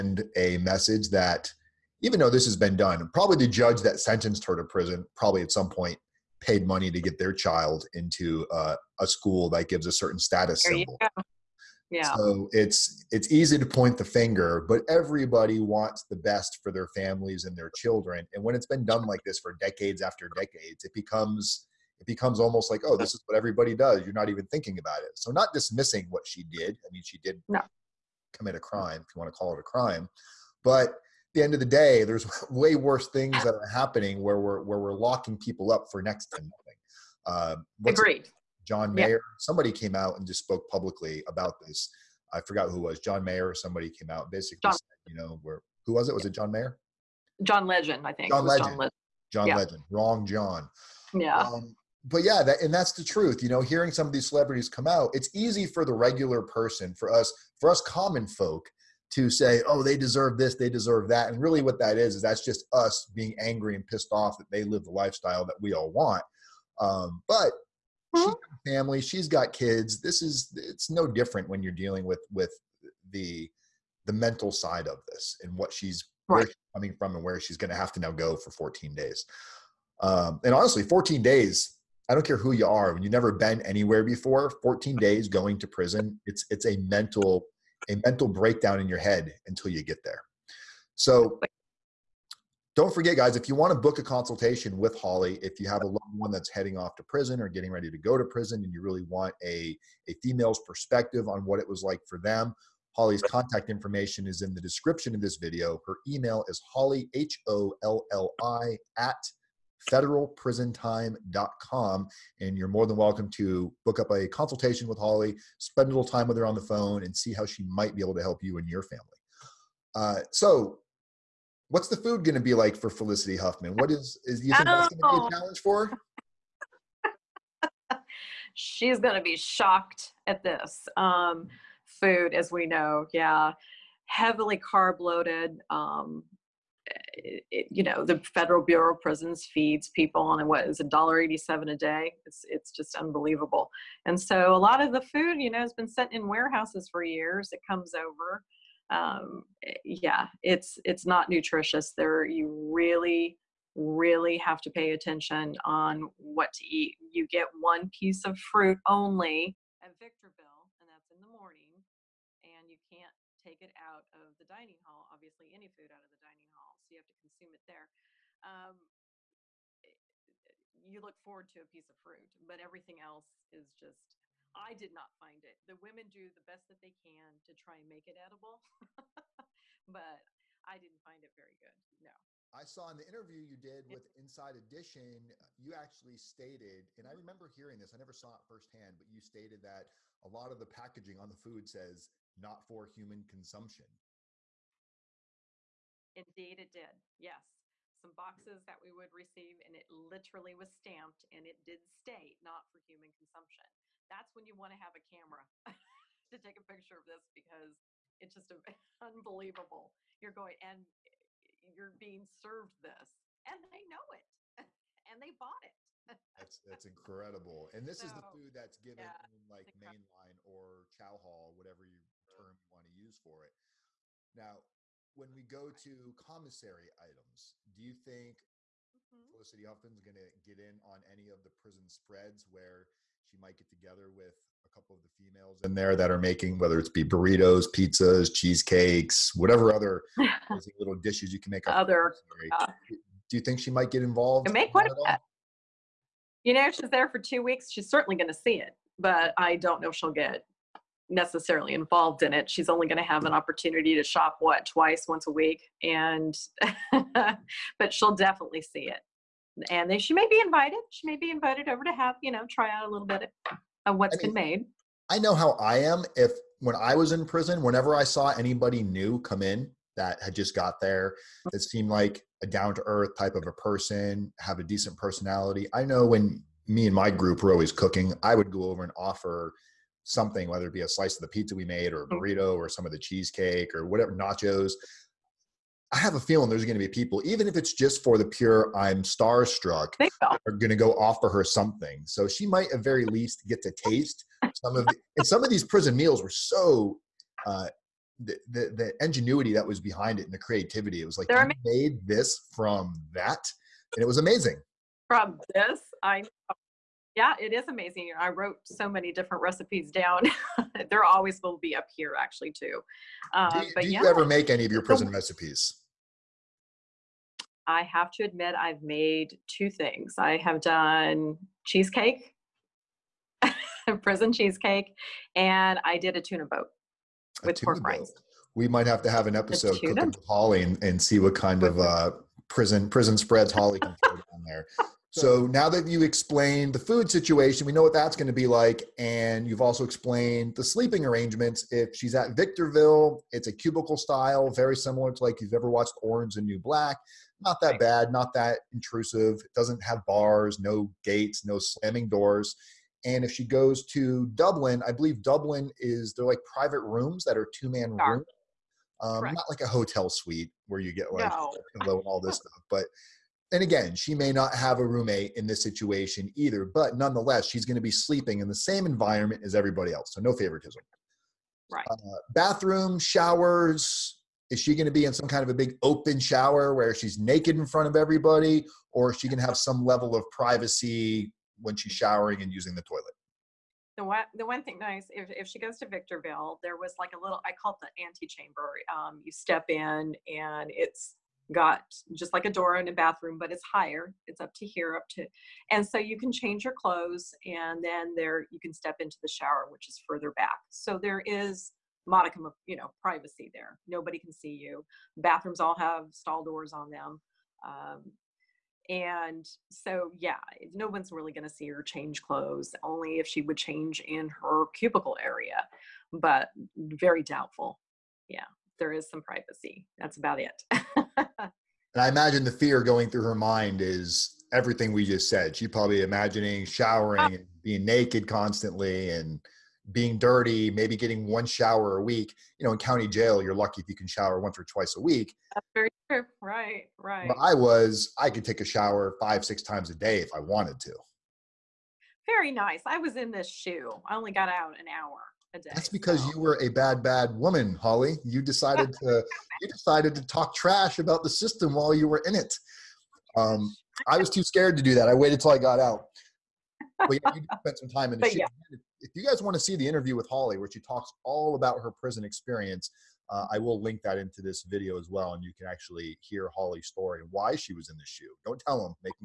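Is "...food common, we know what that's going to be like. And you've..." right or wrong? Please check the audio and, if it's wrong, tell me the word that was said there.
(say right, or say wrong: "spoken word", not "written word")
wrong: "situation", not "common".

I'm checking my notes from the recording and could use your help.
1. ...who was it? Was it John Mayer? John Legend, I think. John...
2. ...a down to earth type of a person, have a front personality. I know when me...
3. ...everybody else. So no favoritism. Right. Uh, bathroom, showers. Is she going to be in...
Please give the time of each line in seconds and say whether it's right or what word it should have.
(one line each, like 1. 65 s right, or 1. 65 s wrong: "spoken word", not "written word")
1. 45 s right
2. 272 s wrong: "decent", not "front"
3. 369 s right.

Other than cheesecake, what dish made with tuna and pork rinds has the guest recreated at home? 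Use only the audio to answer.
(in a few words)
Tuna boat.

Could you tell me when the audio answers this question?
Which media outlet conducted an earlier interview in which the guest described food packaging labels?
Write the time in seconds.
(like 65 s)
184 s.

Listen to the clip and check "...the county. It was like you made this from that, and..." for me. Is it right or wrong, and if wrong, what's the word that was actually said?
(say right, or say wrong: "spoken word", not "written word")
wrong: "creativity", not "county".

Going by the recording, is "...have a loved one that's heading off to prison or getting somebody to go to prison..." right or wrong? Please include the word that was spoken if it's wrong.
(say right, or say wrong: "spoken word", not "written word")
wrong: "ready", not "somebody".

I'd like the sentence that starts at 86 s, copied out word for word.
It's it's a mental a mental breakdown in your head until you get there.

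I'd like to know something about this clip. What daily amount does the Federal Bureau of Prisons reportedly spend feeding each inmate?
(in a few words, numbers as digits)
$1.87.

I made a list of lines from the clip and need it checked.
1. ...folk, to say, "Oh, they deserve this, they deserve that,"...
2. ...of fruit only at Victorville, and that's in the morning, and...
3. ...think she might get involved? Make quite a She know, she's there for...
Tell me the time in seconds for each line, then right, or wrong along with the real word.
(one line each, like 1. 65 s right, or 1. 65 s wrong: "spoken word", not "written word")
1. 58 s right
2. 158 s right
3. 243 s wrong: "You", not "She".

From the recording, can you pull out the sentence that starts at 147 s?
It comes over um, eh, yeah, it's it's not nutritious.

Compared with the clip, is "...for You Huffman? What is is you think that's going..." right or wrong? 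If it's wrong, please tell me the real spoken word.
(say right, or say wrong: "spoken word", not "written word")
wrong: "Felicity", not "You".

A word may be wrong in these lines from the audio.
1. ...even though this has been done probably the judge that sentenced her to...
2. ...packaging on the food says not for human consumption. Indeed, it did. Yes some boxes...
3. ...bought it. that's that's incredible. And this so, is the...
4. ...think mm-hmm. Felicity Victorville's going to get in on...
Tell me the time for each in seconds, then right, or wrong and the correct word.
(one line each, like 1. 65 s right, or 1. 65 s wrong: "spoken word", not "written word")
1. 2 s right
2. 190 s right
3. 215 s right
4. 227 s wrong: "Huffman", not "Victorville".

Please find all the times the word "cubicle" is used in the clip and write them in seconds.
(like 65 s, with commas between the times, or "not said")
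343 s, 414 s.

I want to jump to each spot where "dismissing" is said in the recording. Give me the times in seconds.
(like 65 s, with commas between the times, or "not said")
25 s.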